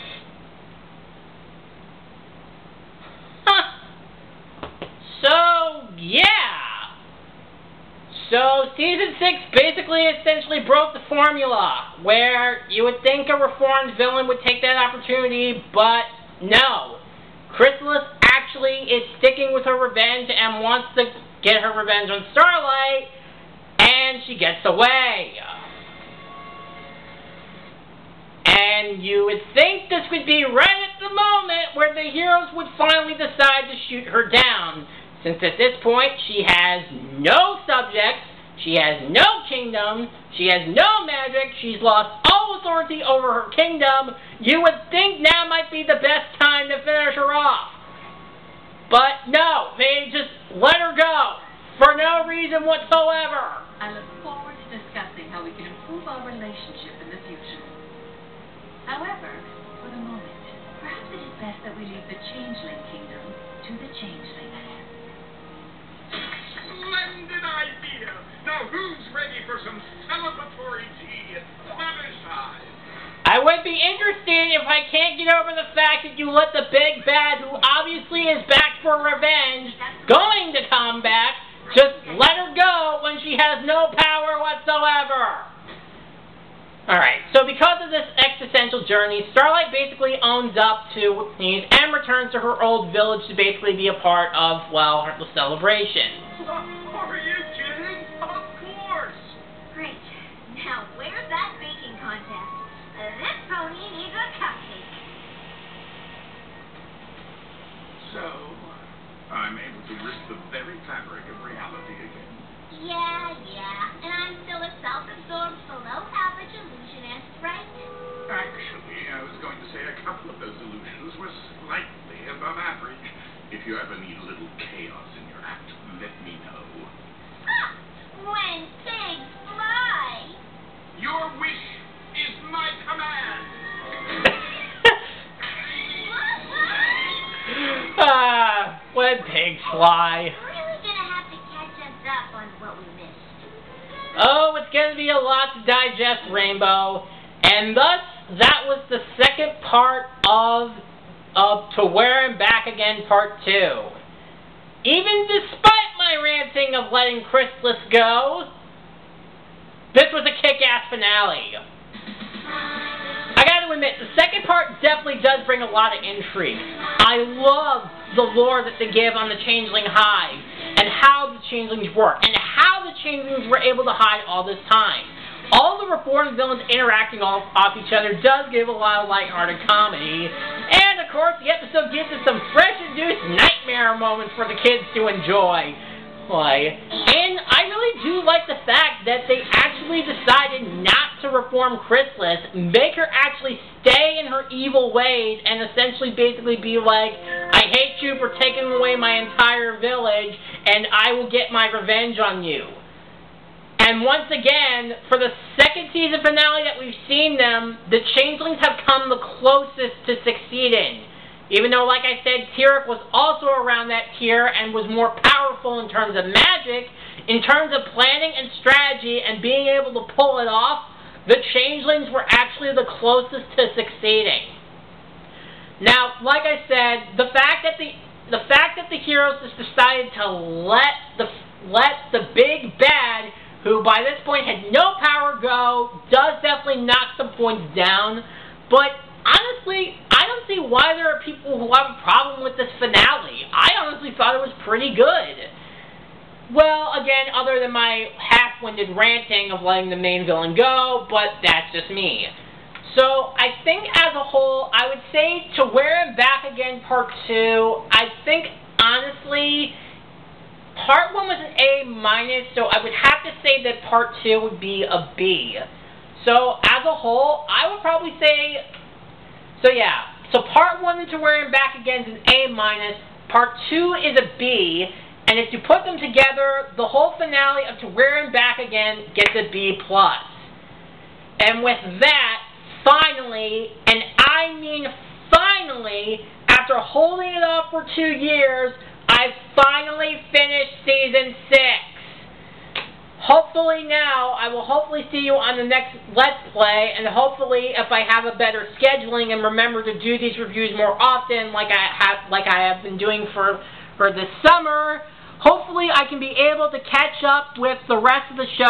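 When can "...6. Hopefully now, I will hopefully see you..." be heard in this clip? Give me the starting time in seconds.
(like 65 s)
291 s.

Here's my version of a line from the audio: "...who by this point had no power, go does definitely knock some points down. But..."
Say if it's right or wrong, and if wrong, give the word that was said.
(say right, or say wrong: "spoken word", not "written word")
right.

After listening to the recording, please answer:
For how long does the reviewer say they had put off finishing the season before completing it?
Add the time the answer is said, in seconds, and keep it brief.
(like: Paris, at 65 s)
two years, at 287 s.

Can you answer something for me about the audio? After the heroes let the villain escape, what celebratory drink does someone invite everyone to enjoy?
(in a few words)
tea.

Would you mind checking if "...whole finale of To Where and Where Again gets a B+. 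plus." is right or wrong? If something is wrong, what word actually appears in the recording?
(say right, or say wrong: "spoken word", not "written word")
wrong: "Back", not "Where".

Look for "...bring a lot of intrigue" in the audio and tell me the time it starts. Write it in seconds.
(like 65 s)
165 s.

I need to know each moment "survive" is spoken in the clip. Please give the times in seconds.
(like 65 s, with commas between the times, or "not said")
not said.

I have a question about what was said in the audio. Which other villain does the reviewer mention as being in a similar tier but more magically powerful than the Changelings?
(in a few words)
Tirek.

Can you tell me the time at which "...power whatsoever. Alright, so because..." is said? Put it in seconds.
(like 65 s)
83 s.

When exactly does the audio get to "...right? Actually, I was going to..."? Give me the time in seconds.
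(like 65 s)
117 s.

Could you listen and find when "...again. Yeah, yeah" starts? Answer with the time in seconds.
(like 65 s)
111 s.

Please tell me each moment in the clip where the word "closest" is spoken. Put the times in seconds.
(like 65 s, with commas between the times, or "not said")
209 s, 222 s.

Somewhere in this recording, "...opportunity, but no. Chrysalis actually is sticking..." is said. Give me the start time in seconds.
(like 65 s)
14 s.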